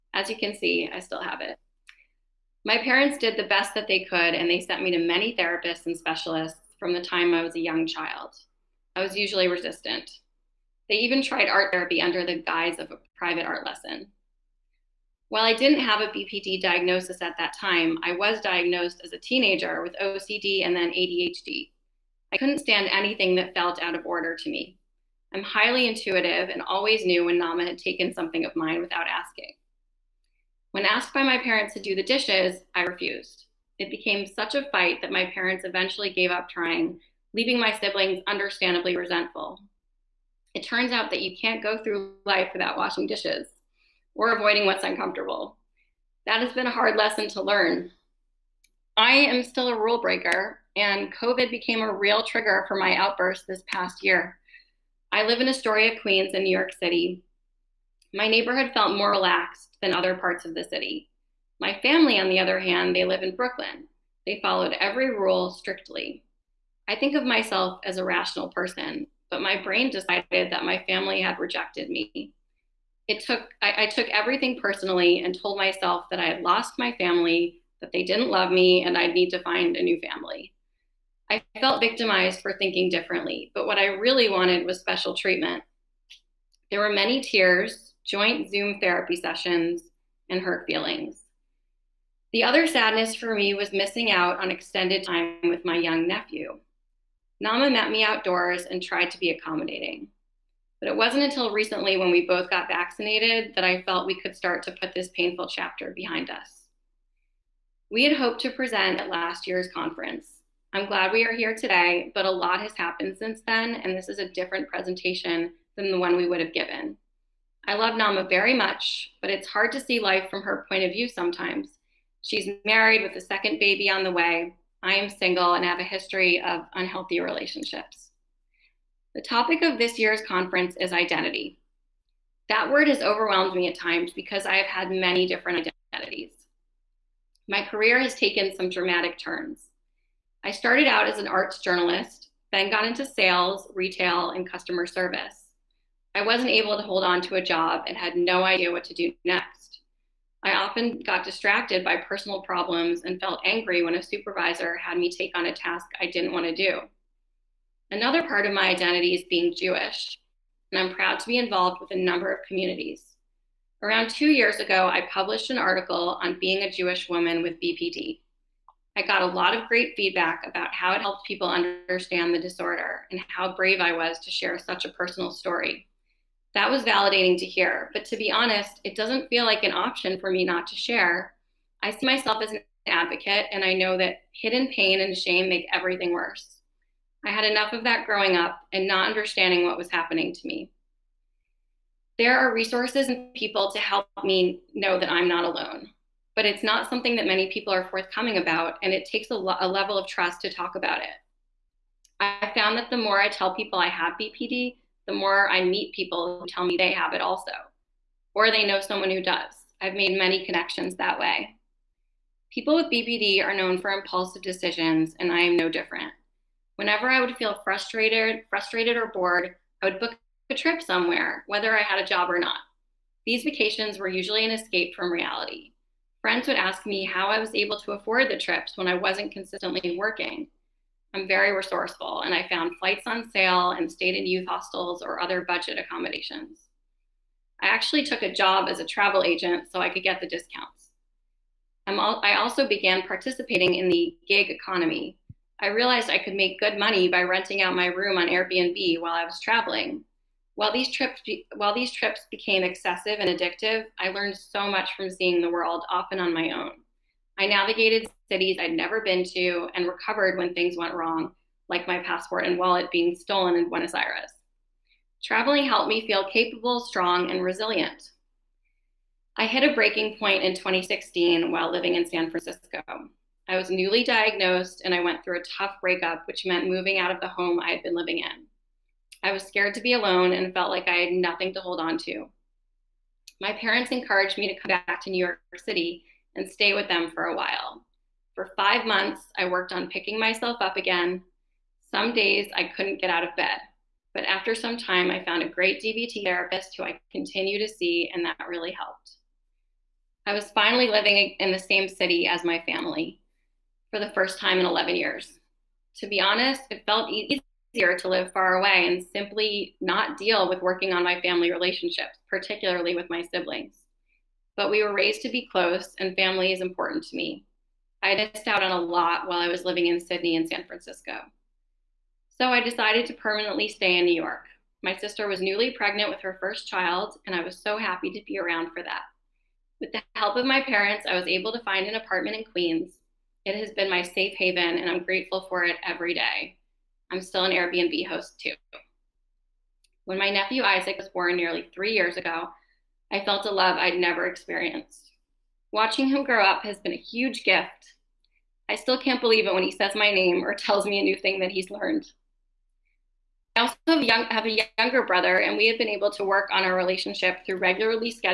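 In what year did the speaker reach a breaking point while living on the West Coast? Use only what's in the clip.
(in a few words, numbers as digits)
2016.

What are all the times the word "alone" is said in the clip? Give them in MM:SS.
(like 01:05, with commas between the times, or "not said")
03:15, 04:39.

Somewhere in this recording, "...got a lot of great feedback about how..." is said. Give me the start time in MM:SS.
02:49.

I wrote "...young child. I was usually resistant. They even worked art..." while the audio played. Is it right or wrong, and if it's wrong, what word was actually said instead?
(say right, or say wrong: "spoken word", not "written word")
wrong: "tried", not "worked".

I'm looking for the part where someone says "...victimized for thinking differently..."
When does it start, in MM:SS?
01:21.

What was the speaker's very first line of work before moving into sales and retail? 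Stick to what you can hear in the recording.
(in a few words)
arts journalist.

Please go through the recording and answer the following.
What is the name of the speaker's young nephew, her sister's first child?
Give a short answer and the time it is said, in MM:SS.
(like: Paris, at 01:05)
Isaac, at 05:40.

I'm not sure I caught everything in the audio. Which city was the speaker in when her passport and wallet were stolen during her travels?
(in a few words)
Buenos Aires.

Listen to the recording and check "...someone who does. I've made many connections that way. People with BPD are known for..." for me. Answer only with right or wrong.
right.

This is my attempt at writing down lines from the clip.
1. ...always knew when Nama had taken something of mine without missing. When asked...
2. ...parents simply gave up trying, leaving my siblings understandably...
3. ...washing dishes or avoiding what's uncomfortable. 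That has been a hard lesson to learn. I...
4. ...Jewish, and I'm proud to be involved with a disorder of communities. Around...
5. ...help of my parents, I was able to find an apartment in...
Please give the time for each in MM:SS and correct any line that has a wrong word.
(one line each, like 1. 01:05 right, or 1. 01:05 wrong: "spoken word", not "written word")
1. 00:26 wrong: "asking", not "missing"
2. 00:35 wrong: "eventually", not "simply"
3. 00:42 right
4. 02:39 wrong: "number", not "disorder"
5. 05:30 right.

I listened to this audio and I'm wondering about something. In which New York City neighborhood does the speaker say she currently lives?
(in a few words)
Astoria, Queens.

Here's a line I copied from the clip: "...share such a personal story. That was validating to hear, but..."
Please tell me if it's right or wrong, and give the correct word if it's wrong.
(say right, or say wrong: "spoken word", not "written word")
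right.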